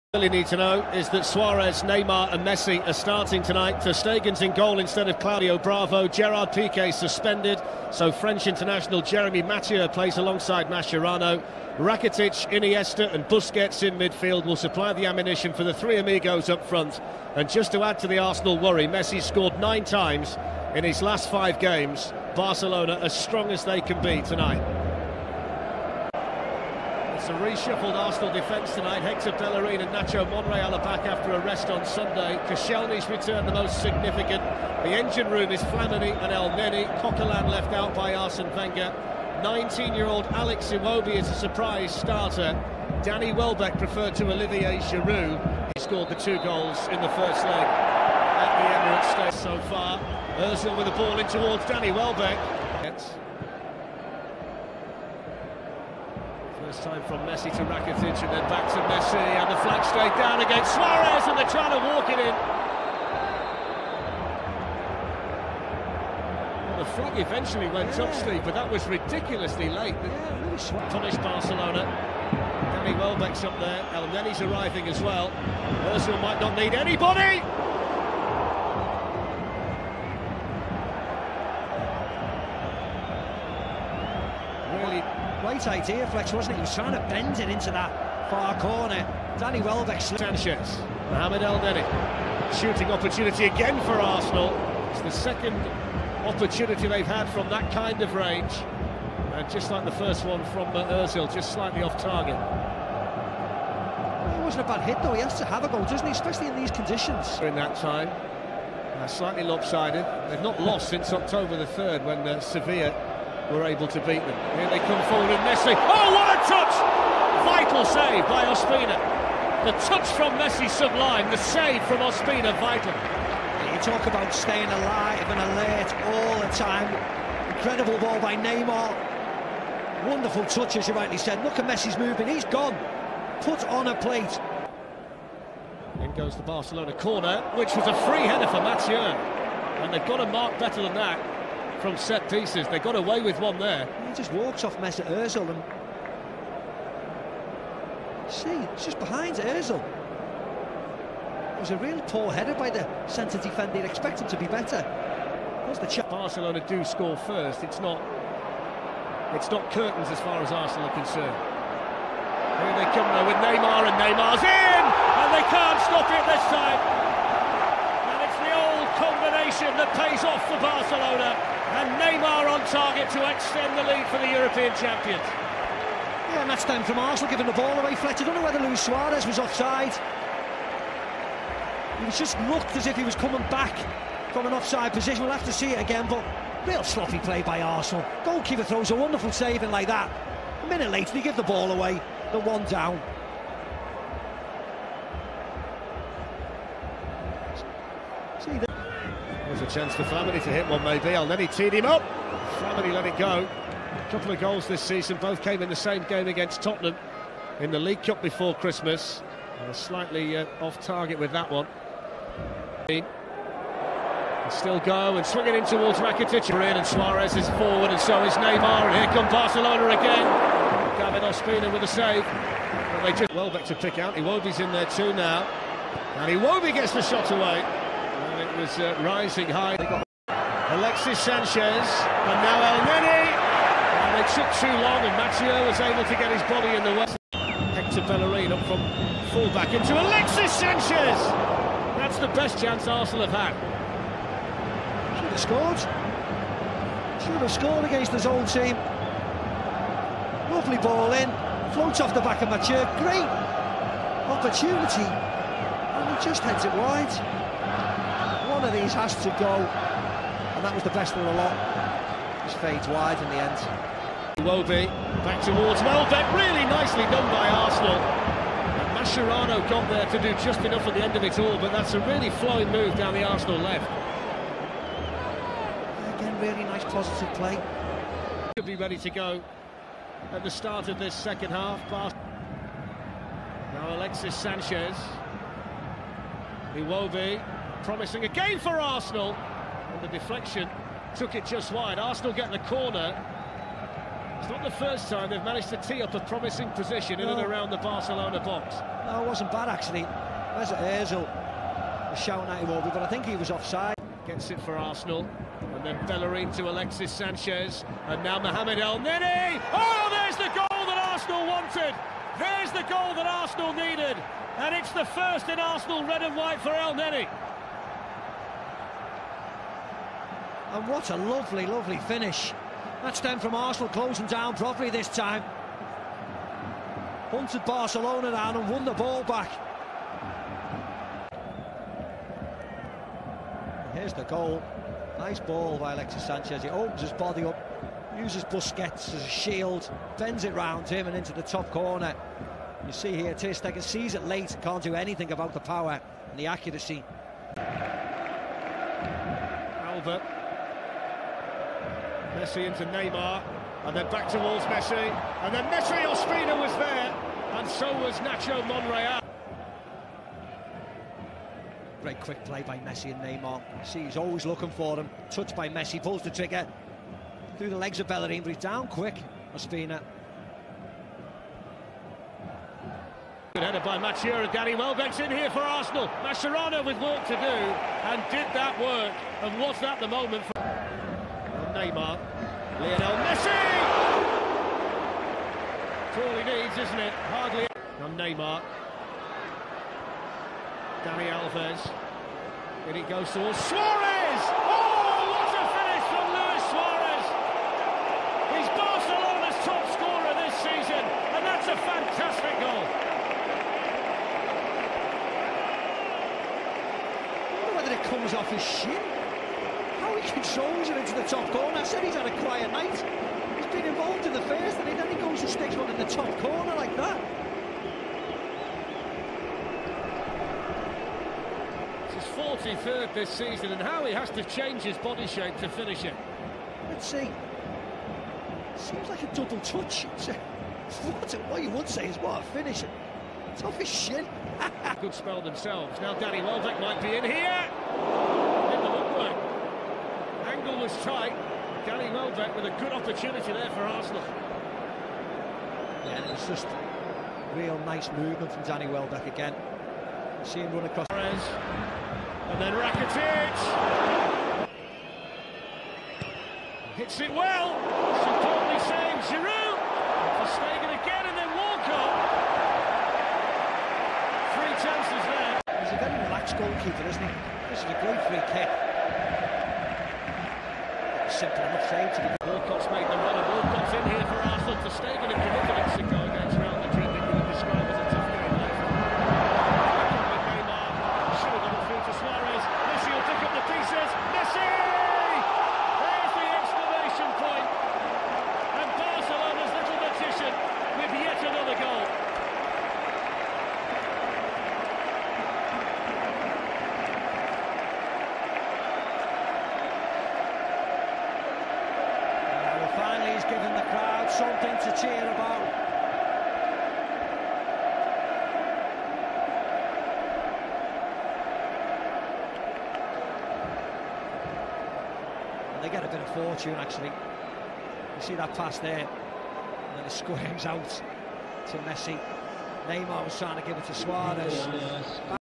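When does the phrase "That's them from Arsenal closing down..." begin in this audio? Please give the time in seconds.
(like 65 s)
323 s.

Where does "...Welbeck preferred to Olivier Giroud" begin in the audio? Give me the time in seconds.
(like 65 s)
43 s.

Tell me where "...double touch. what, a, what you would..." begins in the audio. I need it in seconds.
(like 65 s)
429 s.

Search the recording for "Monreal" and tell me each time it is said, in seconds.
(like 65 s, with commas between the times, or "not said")
30 s, 358 s.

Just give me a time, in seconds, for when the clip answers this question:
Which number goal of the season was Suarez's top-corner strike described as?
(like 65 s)
422 s.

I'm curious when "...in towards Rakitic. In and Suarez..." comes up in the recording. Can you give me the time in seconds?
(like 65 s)
215 s.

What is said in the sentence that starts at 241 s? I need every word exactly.
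That's the best chance Arsenal have had.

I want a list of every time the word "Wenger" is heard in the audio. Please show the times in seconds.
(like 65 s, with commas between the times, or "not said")
38 s.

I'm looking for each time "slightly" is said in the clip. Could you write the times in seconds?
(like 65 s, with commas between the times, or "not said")
101 s, 109 s, 209 s.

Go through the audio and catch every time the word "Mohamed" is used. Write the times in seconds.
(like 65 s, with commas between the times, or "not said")
91 s, 308 s.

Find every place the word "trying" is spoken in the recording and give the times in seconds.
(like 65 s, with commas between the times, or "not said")
61 s, 86 s, 523 s.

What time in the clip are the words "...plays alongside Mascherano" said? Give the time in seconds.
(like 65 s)
9 s.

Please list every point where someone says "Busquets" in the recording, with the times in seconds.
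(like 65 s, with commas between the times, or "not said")
13 s, 338 s.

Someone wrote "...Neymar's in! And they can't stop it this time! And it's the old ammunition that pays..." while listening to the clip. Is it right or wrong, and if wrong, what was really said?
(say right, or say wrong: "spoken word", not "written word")
wrong: "combination", not "ammunition".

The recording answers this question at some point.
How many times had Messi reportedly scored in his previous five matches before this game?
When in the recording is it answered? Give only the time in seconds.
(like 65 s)
19 s.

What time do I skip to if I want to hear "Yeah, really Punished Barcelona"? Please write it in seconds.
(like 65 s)
69 s.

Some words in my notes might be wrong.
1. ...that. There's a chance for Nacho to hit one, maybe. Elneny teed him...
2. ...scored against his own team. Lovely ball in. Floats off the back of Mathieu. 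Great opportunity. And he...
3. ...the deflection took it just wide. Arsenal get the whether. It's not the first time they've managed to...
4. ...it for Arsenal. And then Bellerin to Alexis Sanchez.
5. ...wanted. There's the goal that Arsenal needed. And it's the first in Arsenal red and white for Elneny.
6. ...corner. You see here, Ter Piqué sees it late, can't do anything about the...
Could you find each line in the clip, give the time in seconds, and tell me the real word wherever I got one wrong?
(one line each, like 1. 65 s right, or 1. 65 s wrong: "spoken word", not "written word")
1. 198 s wrong: "Flamini", not "Nacho"
2. 247 s right
3. 290 s wrong: "corner", not "whether"
4. 304 s right
5. 311 s right
6. 341 s wrong: "Stegen", not "Piqué".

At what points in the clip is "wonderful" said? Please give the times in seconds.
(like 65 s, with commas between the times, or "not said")
130 s, 188 s.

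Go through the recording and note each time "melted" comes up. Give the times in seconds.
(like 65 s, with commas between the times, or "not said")
not said.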